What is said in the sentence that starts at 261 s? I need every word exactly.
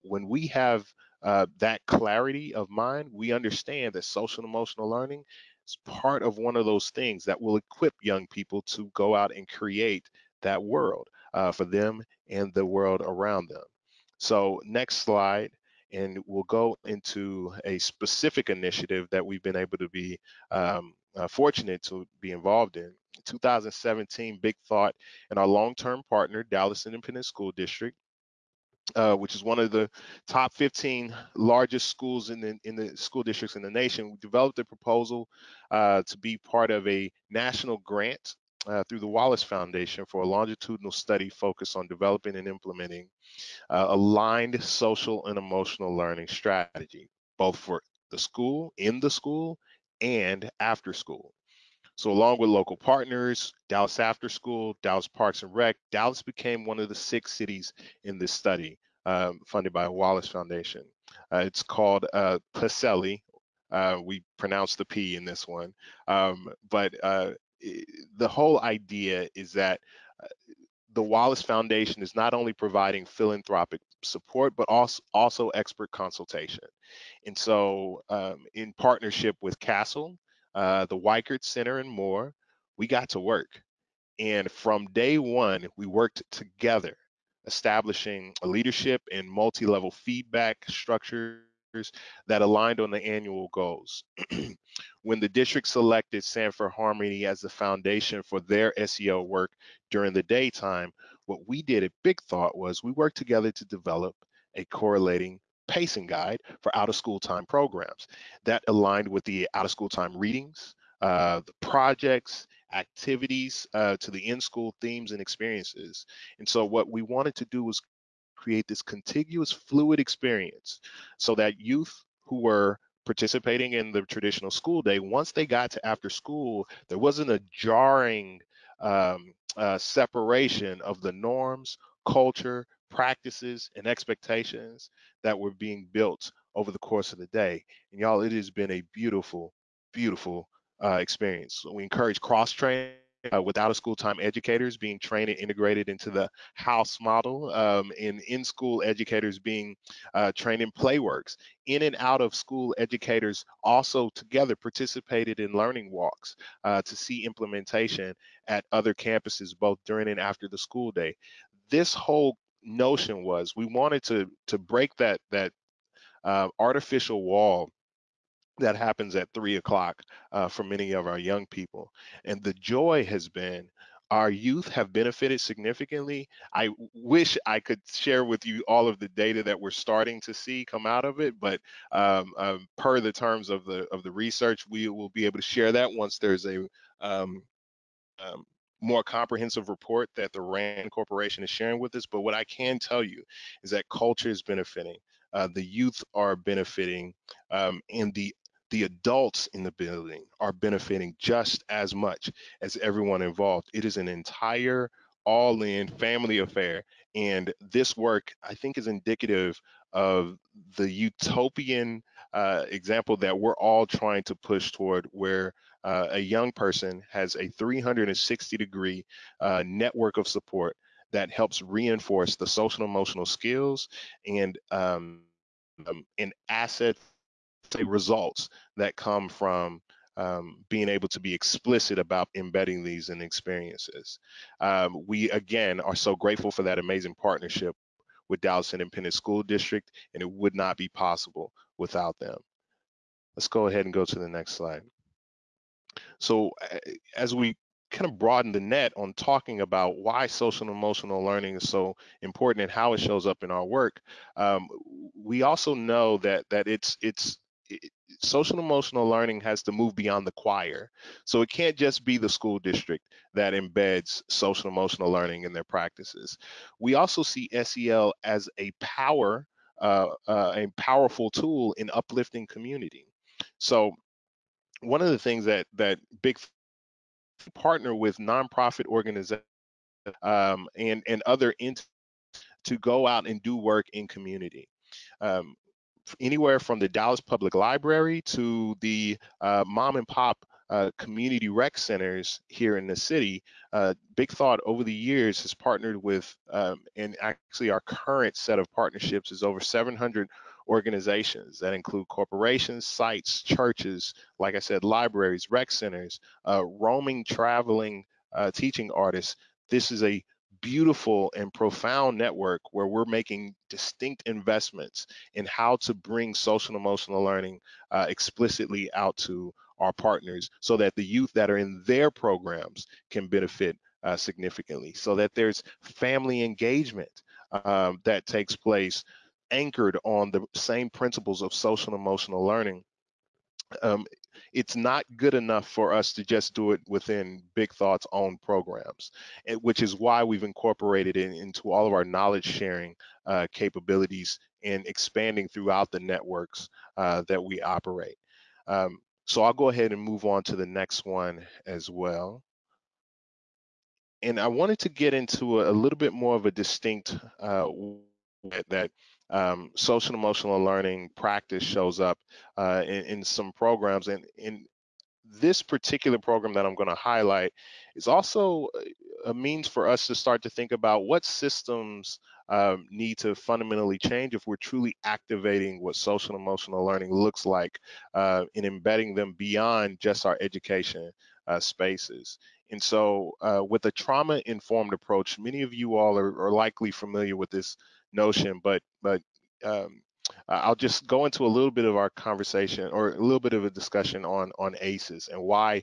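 So it can't just be the school district that embeds social emotional learning in their practices.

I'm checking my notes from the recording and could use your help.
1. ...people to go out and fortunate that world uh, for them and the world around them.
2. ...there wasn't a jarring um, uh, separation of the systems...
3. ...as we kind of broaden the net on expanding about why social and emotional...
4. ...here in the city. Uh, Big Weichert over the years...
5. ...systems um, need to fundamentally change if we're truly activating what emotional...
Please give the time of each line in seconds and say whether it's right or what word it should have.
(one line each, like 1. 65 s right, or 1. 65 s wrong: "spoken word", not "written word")
1. 8 s wrong: "create", not "fortunate"
2. 126 s wrong: "norms", not "systems"
3. 247 s wrong: "talking", not "expanding"
4. 292 s wrong: "Thought", not "Weichert"
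5. 371 s wrong: "social", not "emotional".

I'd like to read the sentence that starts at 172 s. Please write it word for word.
And the joy has been our youth have benefited significantly.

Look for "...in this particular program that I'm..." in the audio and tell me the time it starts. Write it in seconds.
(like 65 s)
364 s.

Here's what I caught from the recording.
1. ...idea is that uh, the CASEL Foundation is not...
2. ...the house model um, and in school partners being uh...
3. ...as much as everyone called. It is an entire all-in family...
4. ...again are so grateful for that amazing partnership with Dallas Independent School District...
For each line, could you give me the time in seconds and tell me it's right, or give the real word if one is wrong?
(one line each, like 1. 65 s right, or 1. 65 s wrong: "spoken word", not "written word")
1. 68 s wrong: "Wallace", not "CASEL"
2. 146 s wrong: "educators", not "partners"
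3. 201 s wrong: "involved", not "called"
4. 235 s right.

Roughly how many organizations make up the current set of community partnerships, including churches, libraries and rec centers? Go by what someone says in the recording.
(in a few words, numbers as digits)
over 700.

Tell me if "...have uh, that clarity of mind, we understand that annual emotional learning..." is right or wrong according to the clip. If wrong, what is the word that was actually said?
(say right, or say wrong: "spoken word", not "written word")
wrong: "social", not "annual".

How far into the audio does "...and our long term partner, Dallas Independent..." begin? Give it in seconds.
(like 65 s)
25 s.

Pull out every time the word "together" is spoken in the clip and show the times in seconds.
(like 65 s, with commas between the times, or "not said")
86 s, 103 s, 154 s.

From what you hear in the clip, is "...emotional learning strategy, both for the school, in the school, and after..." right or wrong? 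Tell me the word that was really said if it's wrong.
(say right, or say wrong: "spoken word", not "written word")
right.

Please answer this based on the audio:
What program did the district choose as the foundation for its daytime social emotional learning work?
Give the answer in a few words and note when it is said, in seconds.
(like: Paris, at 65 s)
Sanford Harmony, at 96 s.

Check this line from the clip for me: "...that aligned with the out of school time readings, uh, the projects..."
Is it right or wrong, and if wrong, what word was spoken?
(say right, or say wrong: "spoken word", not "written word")
right.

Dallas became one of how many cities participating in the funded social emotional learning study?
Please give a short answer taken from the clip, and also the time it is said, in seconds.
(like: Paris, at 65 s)
6, at 56 s.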